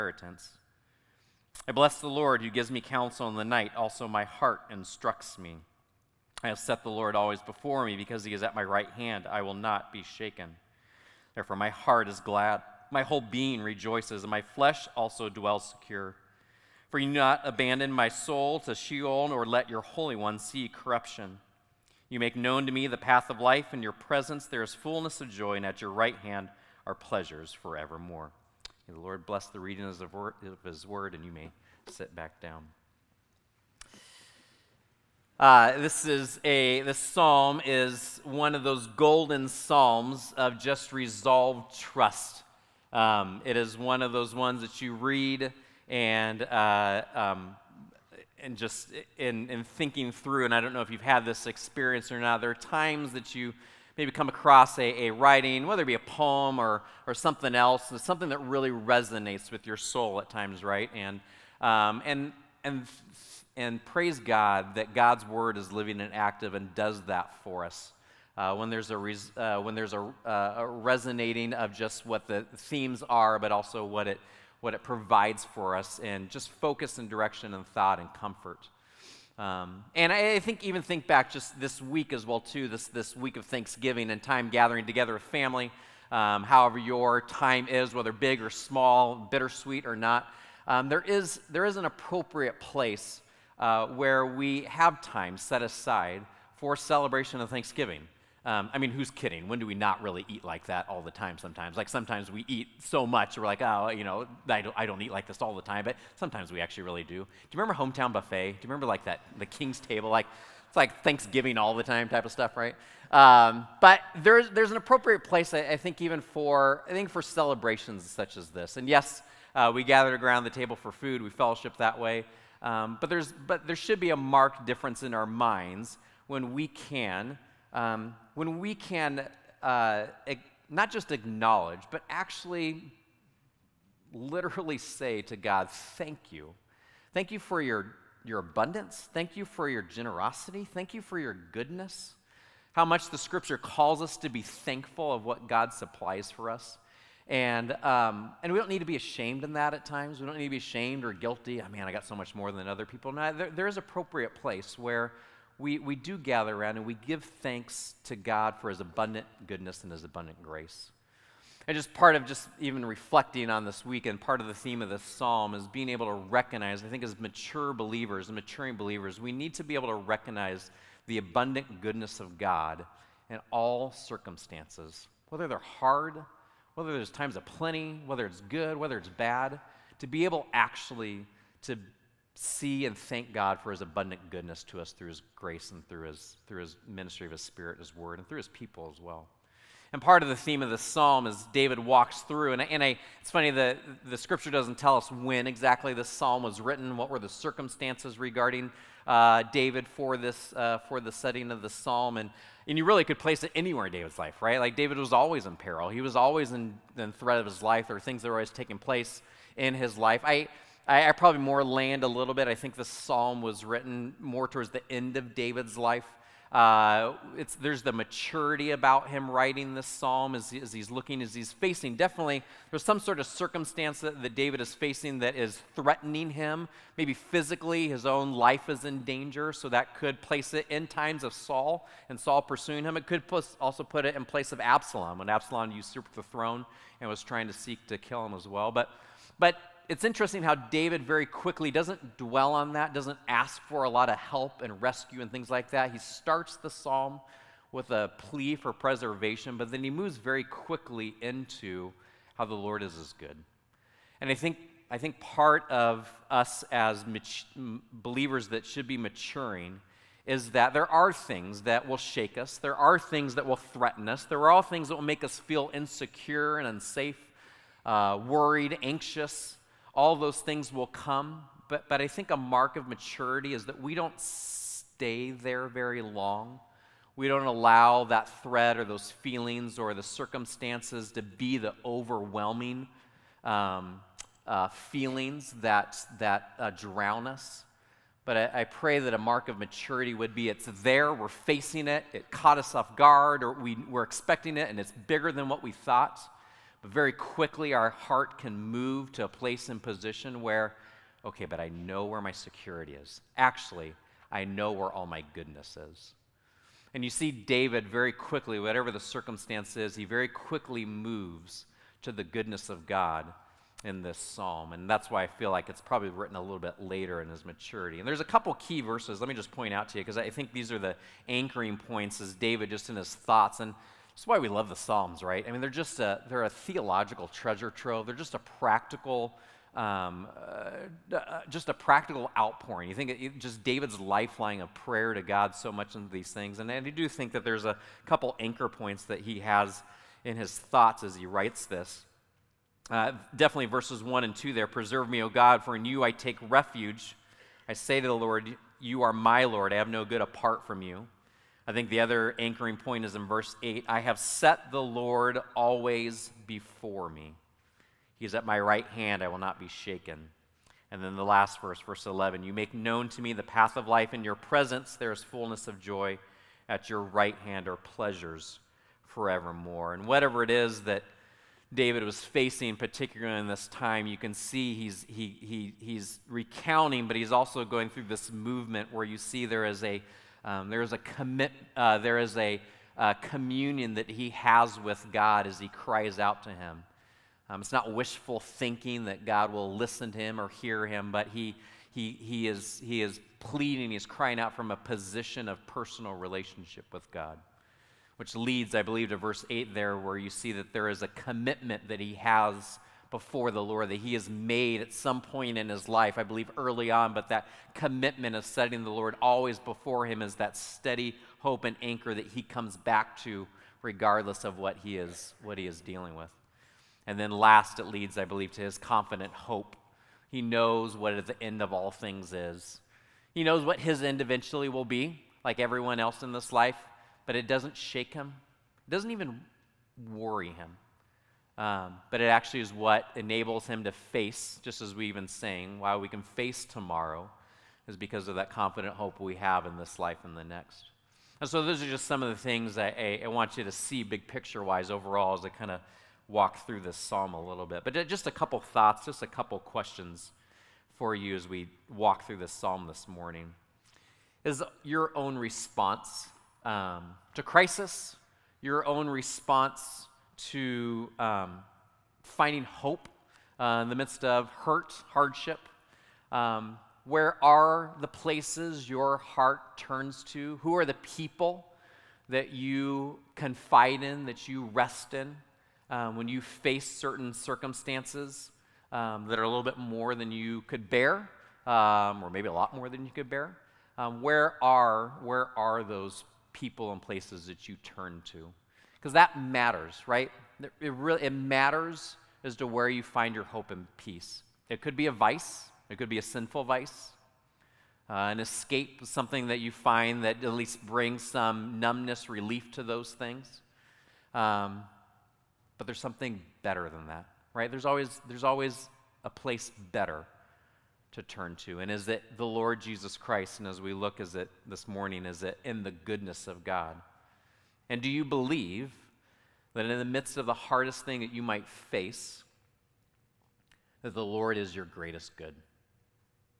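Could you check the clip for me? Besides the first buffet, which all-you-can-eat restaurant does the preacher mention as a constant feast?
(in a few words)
King's Table.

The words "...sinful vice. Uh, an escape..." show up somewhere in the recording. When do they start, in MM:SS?
08:16.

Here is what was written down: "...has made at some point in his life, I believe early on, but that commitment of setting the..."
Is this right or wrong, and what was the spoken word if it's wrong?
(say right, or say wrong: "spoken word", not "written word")
right.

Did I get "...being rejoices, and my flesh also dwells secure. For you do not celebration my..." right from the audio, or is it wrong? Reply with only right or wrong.
wrong.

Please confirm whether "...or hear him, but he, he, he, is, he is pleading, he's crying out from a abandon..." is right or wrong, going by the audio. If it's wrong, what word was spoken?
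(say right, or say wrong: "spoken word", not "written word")
wrong: "position", not "abandon".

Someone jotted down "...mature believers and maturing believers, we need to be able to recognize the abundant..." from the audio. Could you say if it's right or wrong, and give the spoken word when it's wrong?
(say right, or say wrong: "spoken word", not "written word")
right.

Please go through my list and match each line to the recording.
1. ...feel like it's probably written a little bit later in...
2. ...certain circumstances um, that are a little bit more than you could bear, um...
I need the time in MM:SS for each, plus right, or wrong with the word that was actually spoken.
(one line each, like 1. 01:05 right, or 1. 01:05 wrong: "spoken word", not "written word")
1. 05:15 right
2. 07:56 right.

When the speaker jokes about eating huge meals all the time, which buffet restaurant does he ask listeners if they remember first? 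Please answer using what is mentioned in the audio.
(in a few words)
Hometown Buffet.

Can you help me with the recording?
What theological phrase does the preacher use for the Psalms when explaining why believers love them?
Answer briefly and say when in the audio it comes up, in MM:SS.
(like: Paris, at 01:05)
treasure trove, at 05:27.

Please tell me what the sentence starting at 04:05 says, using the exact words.
He starts the psalm with a plea for preservation, but then he moves very quickly into how the Lord is as good.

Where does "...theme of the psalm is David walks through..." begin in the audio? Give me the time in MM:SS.
03:10.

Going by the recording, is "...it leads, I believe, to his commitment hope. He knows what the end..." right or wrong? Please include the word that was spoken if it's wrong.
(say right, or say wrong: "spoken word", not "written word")
wrong: "confident", not "commitment".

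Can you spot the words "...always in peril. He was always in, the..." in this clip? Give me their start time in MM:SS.
03:25.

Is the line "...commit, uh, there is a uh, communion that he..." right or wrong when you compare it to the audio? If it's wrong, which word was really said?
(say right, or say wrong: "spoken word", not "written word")
right.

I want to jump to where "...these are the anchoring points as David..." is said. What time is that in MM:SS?
05:20.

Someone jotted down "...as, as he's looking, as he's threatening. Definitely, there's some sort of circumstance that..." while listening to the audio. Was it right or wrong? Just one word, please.
wrong.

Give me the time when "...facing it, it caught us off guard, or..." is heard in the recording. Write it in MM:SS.
04:51.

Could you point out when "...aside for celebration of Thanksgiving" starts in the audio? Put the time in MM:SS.
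01:35.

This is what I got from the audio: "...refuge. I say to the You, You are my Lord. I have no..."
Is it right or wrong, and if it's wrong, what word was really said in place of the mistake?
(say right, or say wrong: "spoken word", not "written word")
wrong: "Lord", not "You".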